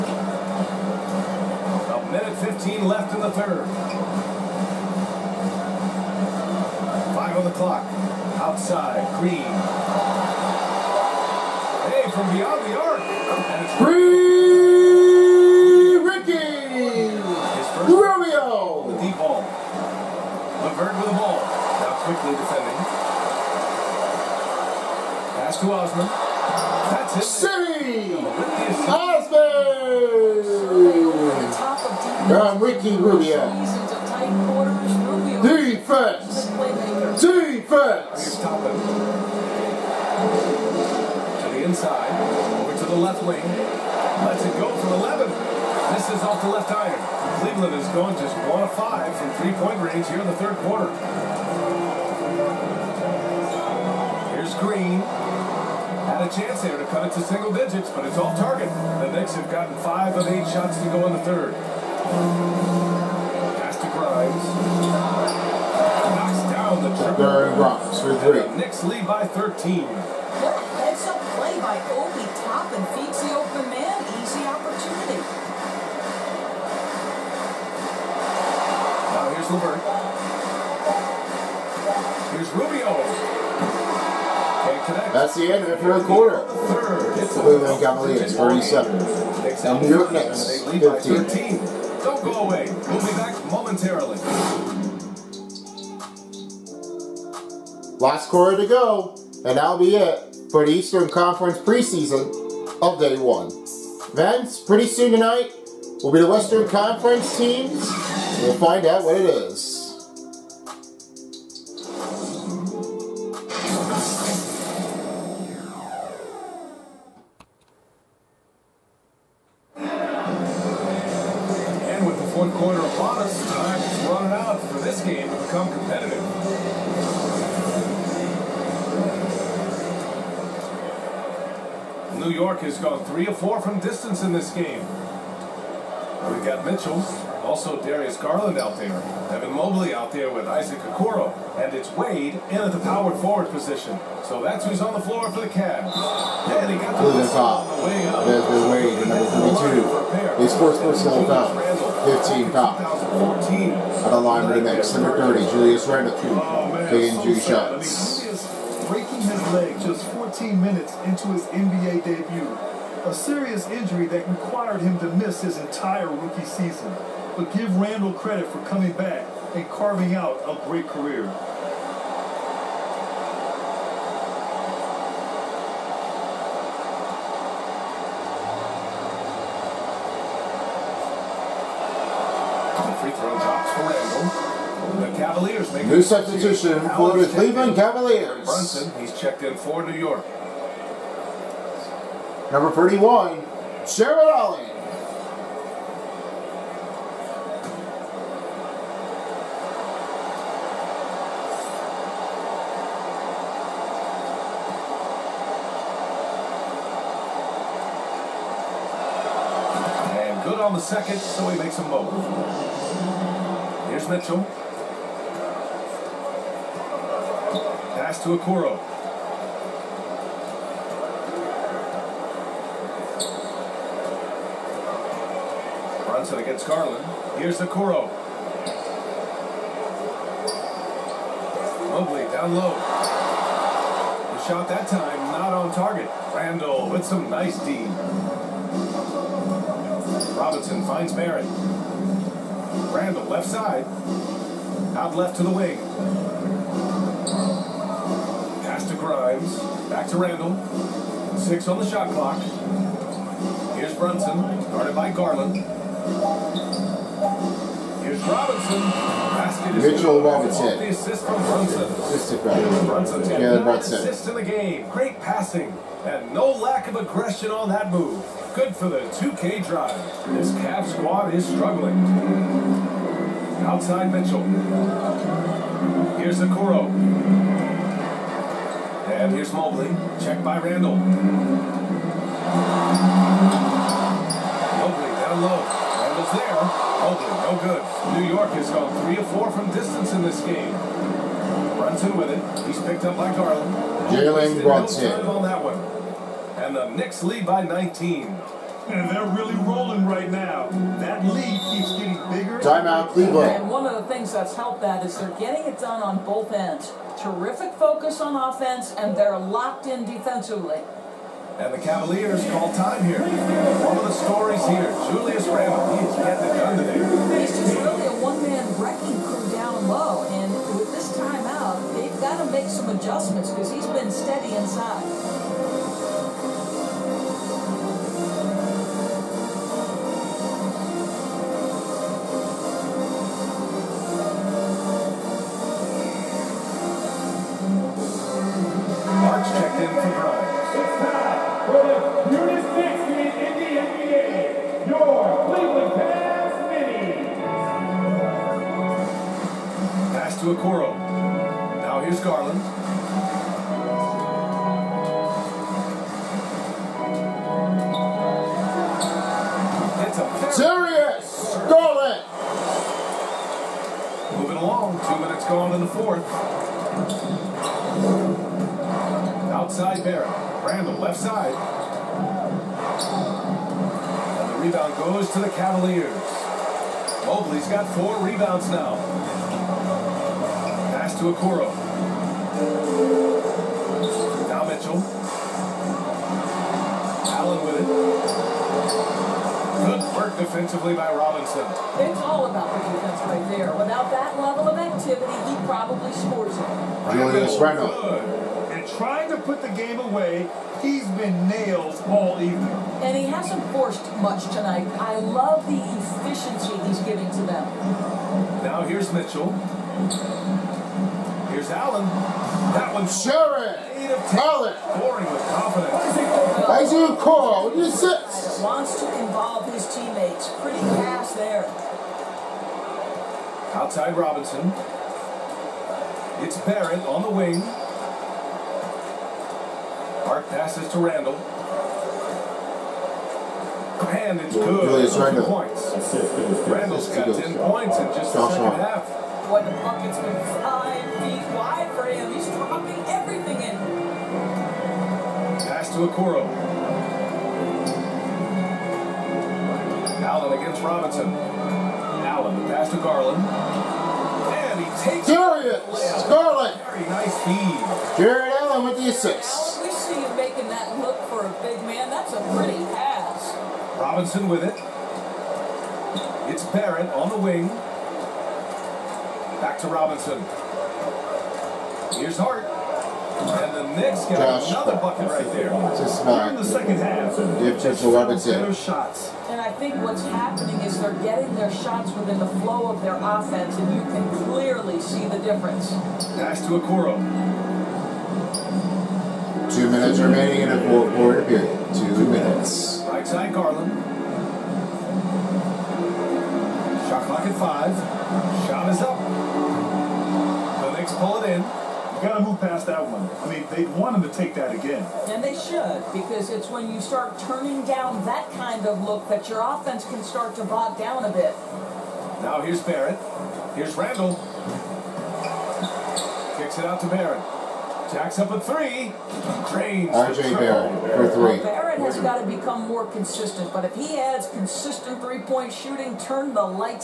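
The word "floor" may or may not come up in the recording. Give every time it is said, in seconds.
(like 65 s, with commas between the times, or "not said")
145 s.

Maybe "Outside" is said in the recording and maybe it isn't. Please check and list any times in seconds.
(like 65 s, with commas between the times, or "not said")
8 s, 273 s, 369 s, 423 s.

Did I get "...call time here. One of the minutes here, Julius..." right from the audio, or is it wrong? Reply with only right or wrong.
wrong.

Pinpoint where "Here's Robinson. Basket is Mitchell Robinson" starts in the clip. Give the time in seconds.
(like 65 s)
258 s.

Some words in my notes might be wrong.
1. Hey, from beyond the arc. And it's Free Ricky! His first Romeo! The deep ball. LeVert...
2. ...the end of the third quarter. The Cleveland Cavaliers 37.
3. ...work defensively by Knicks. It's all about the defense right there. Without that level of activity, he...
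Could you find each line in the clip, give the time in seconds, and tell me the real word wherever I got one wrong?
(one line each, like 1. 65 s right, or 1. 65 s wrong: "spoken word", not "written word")
1. 11 s right
2. 85 s wrong: "47", not "37"
3. 390 s wrong: "Robinson", not "Knicks".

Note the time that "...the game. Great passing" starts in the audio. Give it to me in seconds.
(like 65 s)
264 s.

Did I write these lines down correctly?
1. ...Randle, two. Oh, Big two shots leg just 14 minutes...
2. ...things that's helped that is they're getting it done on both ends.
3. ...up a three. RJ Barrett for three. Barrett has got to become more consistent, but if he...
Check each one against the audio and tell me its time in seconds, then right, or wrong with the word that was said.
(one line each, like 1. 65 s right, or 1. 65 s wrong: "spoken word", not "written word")
1. 155 s right
2. 304 s right
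3. 518 s right.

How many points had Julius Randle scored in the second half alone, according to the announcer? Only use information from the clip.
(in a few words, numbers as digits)
10.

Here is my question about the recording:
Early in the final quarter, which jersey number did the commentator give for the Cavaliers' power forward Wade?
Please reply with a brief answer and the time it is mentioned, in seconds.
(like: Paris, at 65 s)
42, at 149 s.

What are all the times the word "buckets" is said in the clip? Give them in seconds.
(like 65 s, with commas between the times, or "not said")
439 s, 474 s.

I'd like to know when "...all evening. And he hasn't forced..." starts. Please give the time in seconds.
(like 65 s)
402 s.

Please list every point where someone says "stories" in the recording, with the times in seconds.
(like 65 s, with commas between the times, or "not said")
314 s.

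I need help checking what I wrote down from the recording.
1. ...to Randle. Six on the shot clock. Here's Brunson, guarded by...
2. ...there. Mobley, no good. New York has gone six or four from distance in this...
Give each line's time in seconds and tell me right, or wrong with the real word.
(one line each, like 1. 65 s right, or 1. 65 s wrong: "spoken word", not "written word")
1. 250 s right
2. 286 s wrong: "three", not "six".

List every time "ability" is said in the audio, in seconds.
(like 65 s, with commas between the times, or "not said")
not said.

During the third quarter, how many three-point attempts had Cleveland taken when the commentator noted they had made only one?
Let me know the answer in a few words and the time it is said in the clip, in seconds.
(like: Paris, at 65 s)
5, at 48 s.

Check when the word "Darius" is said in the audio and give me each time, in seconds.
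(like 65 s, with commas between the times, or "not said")
137 s, 455 s.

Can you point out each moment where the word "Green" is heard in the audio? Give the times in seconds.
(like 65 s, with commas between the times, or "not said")
9 s, 54 s.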